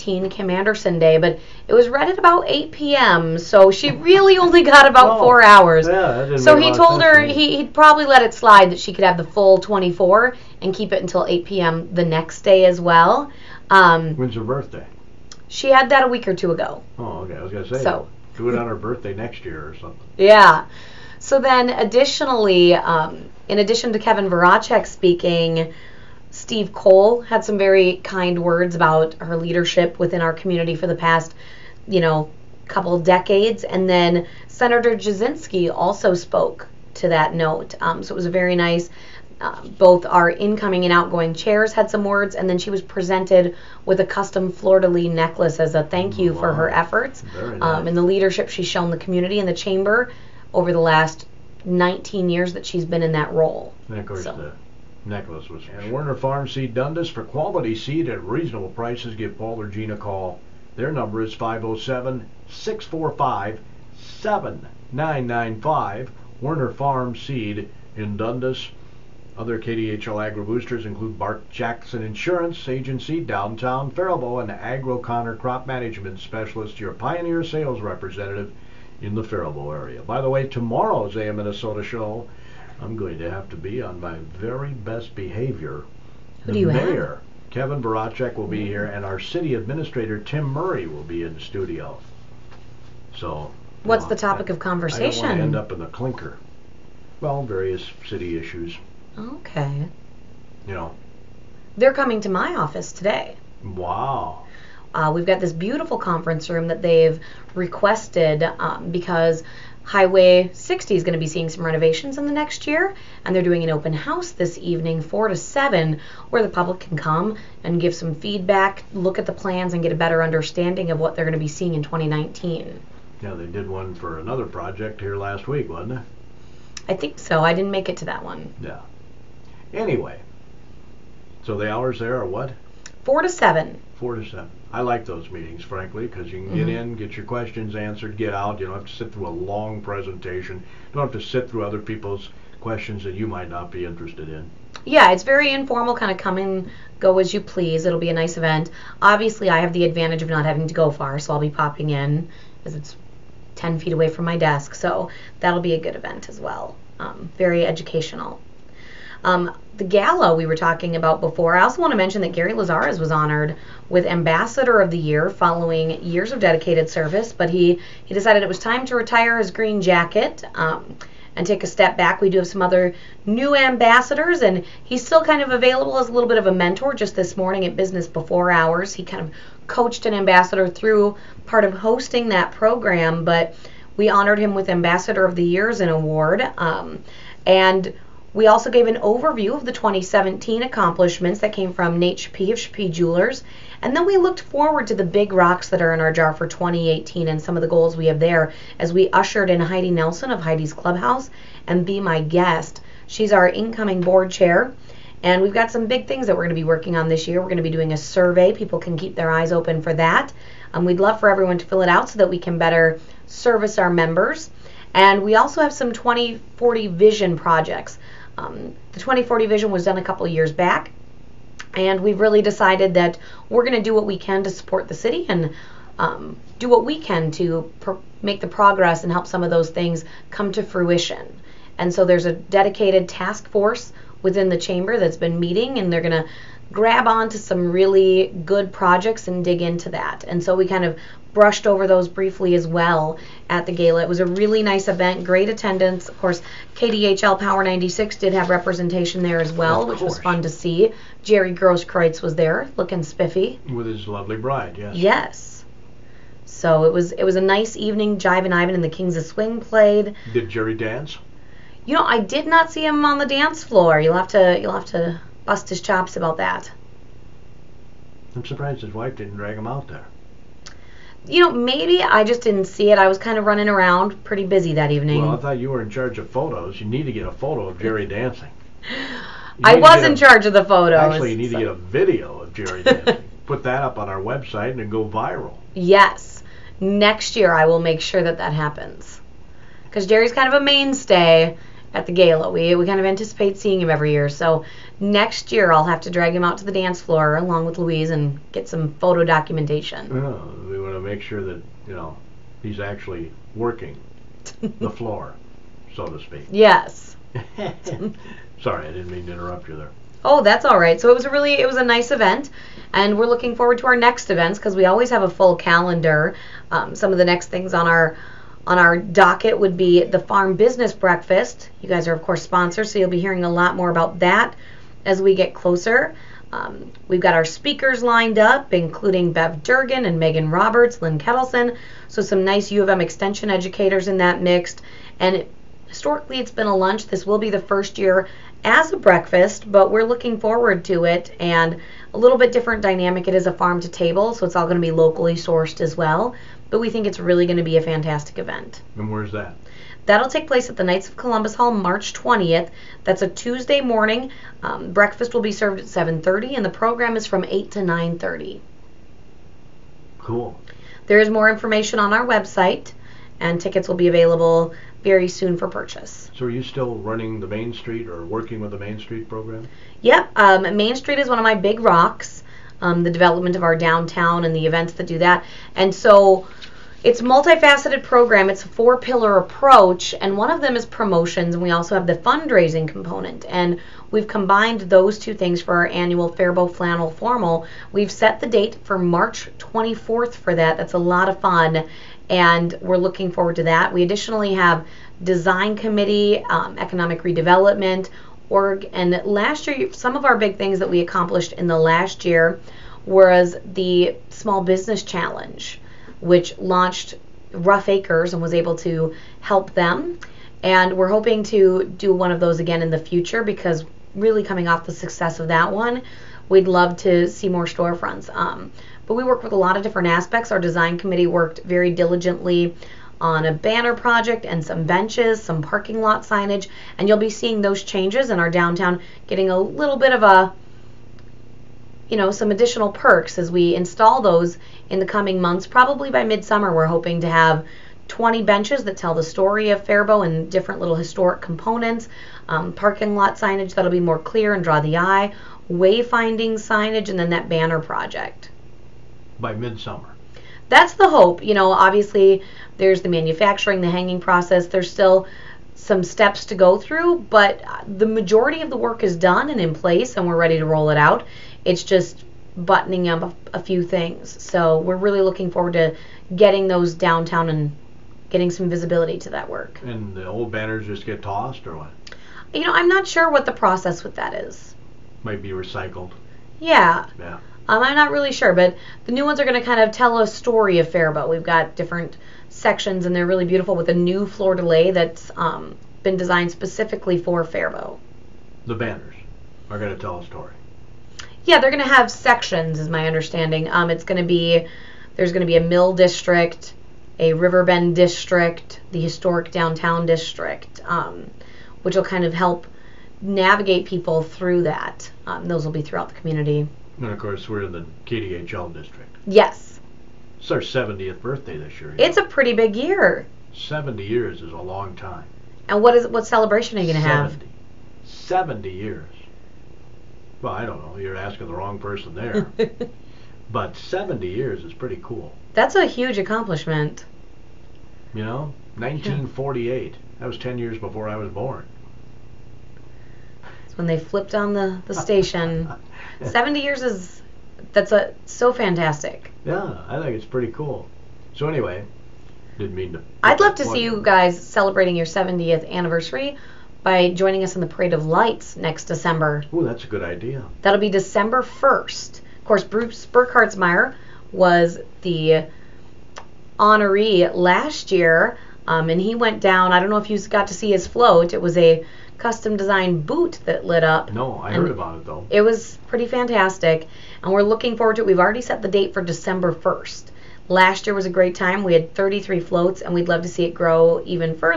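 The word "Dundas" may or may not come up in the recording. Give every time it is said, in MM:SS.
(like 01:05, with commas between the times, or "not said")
00:56, 01:08.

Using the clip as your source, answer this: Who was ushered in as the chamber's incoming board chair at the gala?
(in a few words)
Heidi Nelson.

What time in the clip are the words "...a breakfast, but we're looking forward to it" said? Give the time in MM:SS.
05:38.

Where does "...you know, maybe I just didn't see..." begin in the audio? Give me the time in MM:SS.
04:31.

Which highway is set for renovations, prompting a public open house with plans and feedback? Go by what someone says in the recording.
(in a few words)
Highway 60.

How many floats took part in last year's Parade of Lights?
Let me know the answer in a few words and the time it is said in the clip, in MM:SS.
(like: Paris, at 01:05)
33, at 09:31.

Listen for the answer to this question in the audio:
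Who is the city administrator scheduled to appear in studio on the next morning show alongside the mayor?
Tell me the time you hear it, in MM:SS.
01:30.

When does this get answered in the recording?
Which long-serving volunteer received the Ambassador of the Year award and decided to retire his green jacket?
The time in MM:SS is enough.
02:42.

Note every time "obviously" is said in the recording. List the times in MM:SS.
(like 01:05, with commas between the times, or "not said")
02:29, 07:31.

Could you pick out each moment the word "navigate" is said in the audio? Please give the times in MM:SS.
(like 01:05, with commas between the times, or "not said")
08:23.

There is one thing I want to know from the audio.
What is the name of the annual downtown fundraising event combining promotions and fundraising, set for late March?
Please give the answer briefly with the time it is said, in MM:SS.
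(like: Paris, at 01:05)
Faribault Flannel Formal, at 06:26.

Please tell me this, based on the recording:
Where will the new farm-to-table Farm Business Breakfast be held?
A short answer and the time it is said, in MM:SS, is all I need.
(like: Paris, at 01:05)
Knights of Columbus Hall, at 05:50.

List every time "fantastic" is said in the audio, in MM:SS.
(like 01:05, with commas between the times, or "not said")
05:47, 08:58, 09:26.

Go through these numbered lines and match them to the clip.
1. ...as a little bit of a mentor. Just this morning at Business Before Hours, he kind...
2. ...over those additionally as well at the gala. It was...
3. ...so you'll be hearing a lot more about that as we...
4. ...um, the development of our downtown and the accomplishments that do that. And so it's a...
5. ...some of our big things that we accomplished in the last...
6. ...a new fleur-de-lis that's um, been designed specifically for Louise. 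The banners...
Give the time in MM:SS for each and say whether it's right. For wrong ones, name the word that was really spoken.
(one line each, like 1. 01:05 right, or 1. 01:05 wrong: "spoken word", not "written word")
1. 02:55 right
2. 04:01 wrong: "briefly", not "additionally"
3. 05:22 right
4. 06:12 wrong: "events", not "accomplishments"
5. 06:39 right
6. 08:03 wrong: "Faribault", not "Louise".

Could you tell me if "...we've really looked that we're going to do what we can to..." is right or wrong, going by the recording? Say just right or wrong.
wrong.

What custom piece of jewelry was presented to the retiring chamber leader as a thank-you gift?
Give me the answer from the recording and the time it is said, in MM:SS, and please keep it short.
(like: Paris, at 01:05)
Fleur-de-lis necklace, at 00:44.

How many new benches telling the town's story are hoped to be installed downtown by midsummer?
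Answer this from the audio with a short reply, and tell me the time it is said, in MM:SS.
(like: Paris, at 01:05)
20, at 07:18.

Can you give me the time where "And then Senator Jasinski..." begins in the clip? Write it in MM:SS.
00:33.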